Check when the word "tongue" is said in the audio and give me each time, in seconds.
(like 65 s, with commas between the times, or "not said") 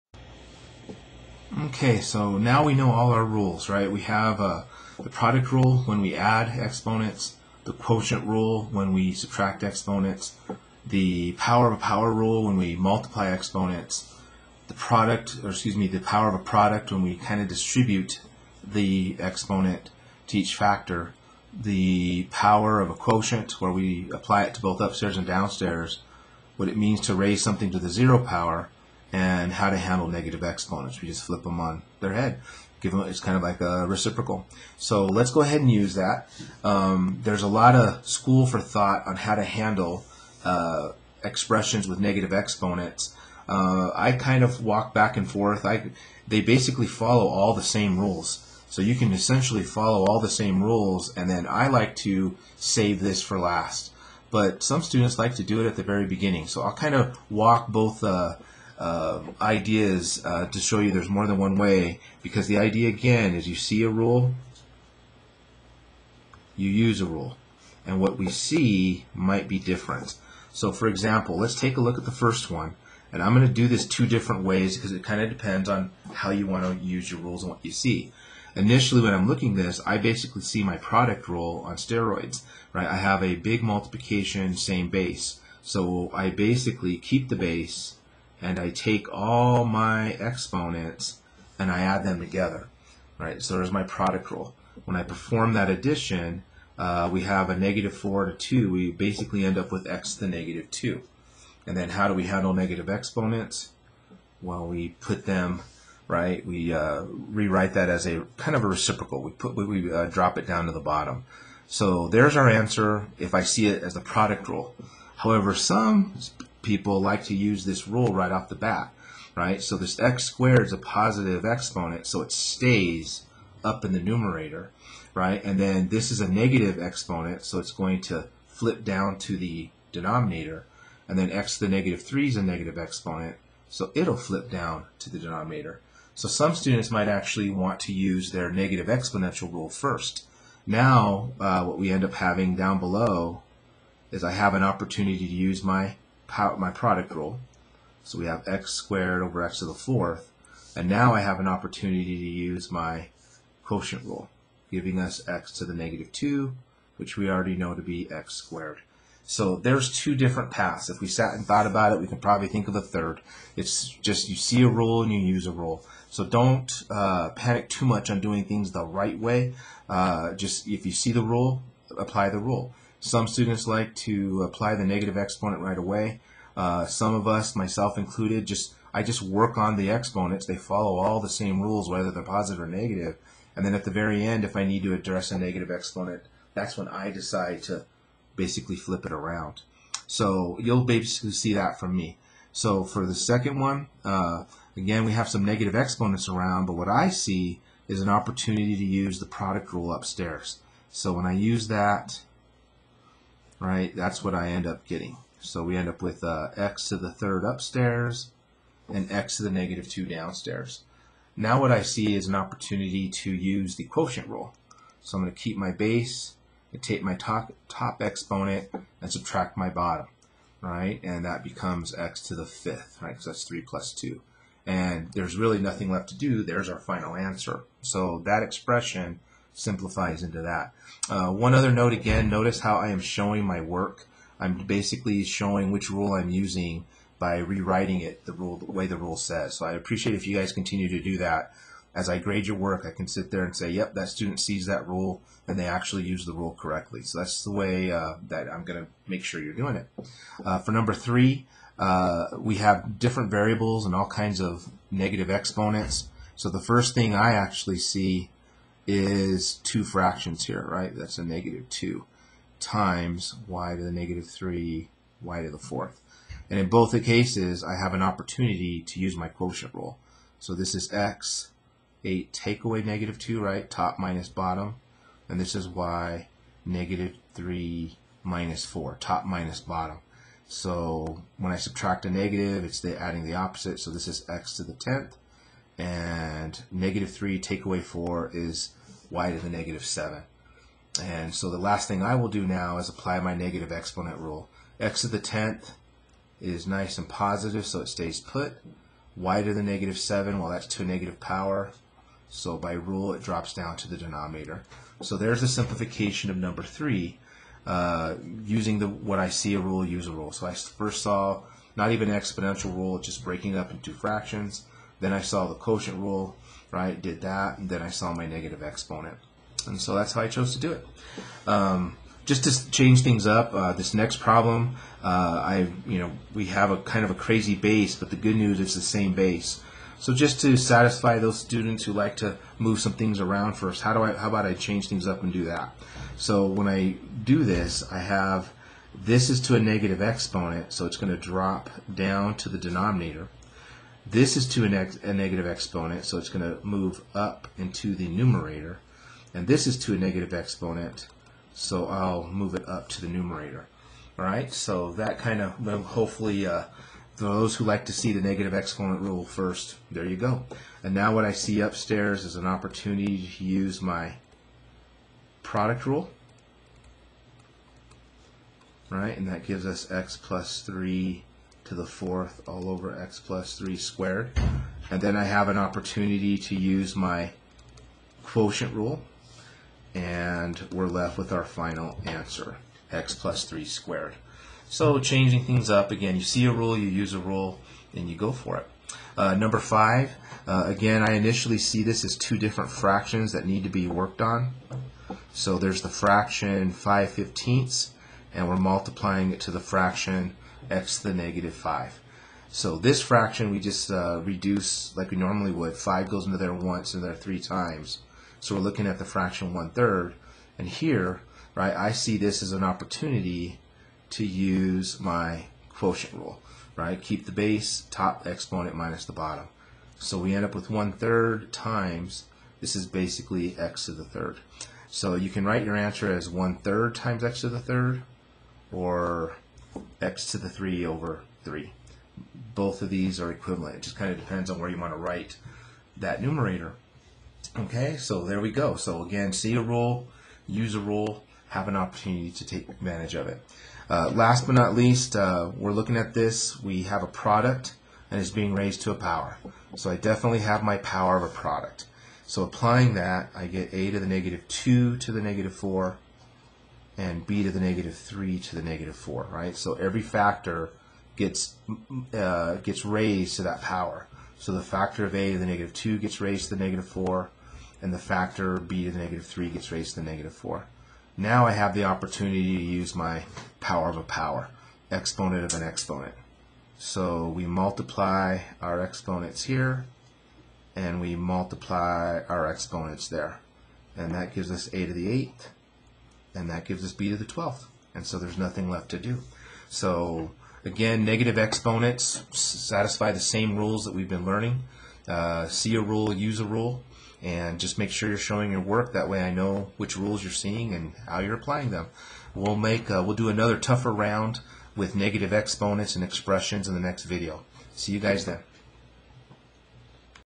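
not said.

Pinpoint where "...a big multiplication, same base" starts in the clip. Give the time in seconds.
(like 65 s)
83 s.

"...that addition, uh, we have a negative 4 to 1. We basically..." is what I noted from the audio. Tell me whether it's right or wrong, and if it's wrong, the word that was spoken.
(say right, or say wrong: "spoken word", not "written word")
wrong: "2", not "1".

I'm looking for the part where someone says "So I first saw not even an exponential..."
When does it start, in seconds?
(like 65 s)
310 s.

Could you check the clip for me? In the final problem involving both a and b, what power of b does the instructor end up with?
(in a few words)
b to the 12th.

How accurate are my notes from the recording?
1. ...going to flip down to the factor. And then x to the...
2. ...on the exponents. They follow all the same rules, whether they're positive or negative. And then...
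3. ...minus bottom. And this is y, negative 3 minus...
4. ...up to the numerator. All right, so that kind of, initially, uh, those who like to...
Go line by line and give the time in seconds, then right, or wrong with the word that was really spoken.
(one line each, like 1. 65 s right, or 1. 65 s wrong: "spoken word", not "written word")
1. 127 s wrong: "denominator", not "factor"
2. 179 s right
3. 273 s right
4. 352 s wrong: "hopefully", not "initially".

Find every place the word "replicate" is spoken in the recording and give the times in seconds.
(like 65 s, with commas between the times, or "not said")
not said.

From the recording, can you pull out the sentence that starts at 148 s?
So we have x squared over x to the fourth.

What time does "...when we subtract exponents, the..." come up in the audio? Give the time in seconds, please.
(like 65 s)
8 s.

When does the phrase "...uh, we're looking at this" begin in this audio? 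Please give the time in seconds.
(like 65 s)
445 s.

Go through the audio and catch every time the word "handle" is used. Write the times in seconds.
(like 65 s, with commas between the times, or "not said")
29 s, 39 s, 102 s.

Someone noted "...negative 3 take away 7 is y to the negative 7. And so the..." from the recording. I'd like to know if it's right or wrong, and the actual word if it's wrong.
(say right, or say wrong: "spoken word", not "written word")
wrong: "4", not "7".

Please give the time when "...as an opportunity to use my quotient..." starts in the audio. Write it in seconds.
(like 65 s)
412 s.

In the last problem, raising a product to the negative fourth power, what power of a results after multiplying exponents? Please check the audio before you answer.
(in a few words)
a to the 8th.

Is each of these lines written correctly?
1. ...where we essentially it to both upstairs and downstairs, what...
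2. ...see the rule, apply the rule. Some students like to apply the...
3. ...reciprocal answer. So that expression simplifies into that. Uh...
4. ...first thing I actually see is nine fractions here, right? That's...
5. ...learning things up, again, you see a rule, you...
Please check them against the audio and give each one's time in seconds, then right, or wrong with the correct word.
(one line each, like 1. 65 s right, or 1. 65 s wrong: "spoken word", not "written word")
1. 23 s wrong: "apply", not "essentially"
2. 170 s right
3. 226 s wrong: "final", not "reciprocal"
4. 256 s wrong: "two", not "nine"
5. 384 s wrong: "changing", not "learning".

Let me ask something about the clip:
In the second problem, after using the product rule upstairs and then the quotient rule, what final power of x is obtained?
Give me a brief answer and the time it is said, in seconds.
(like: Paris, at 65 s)
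x to the 5th, at 221 s.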